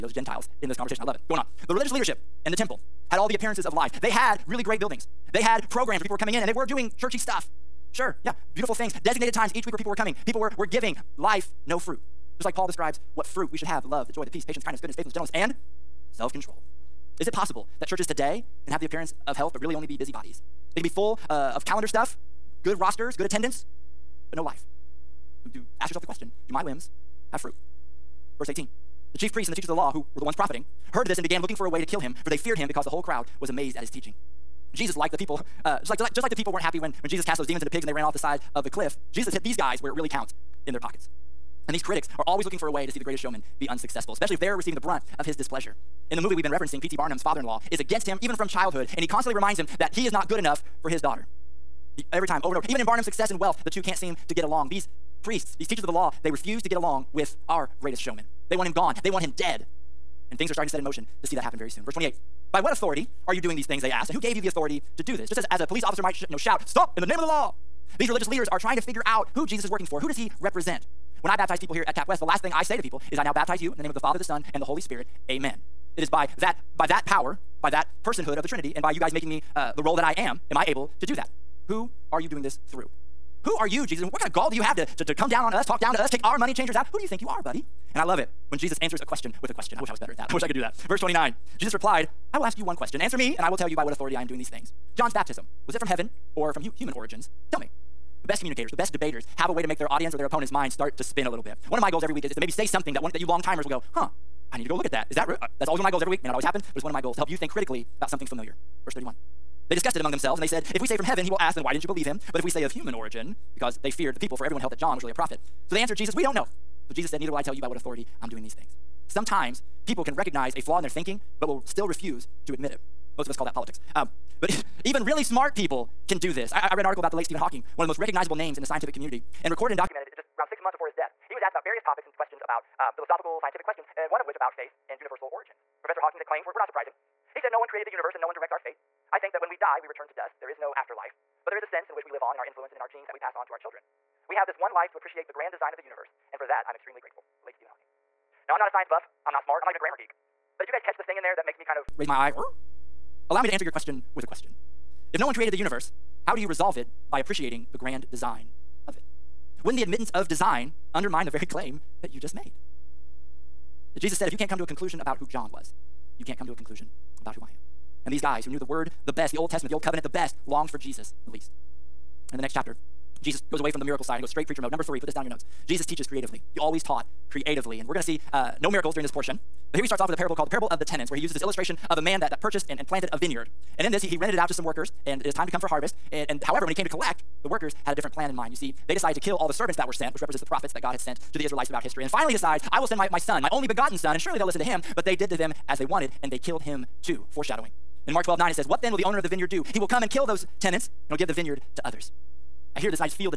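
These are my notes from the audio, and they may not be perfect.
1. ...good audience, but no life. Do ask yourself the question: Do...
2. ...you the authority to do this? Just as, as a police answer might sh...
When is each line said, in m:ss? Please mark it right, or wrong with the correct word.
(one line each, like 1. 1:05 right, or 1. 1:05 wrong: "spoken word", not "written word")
1. 0:23 wrong: "attendance", not "audience"
2. 1:04 wrong: "officer", not "answer".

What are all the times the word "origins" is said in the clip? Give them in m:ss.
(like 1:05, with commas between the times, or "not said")
1:36, 1:52, 2:15.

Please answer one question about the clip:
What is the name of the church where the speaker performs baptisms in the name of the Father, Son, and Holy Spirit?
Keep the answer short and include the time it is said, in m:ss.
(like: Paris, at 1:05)
Cap West, at 1:11.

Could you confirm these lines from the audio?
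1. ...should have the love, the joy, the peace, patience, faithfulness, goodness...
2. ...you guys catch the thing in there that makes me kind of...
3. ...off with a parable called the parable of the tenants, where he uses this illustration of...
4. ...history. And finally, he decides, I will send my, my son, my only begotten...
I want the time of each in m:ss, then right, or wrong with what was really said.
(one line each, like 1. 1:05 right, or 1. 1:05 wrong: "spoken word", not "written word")
1. 0:13 wrong: "kindness", not "faithfulness"
2. 2:30 right
3. 2:59 right
4. 3:11 right.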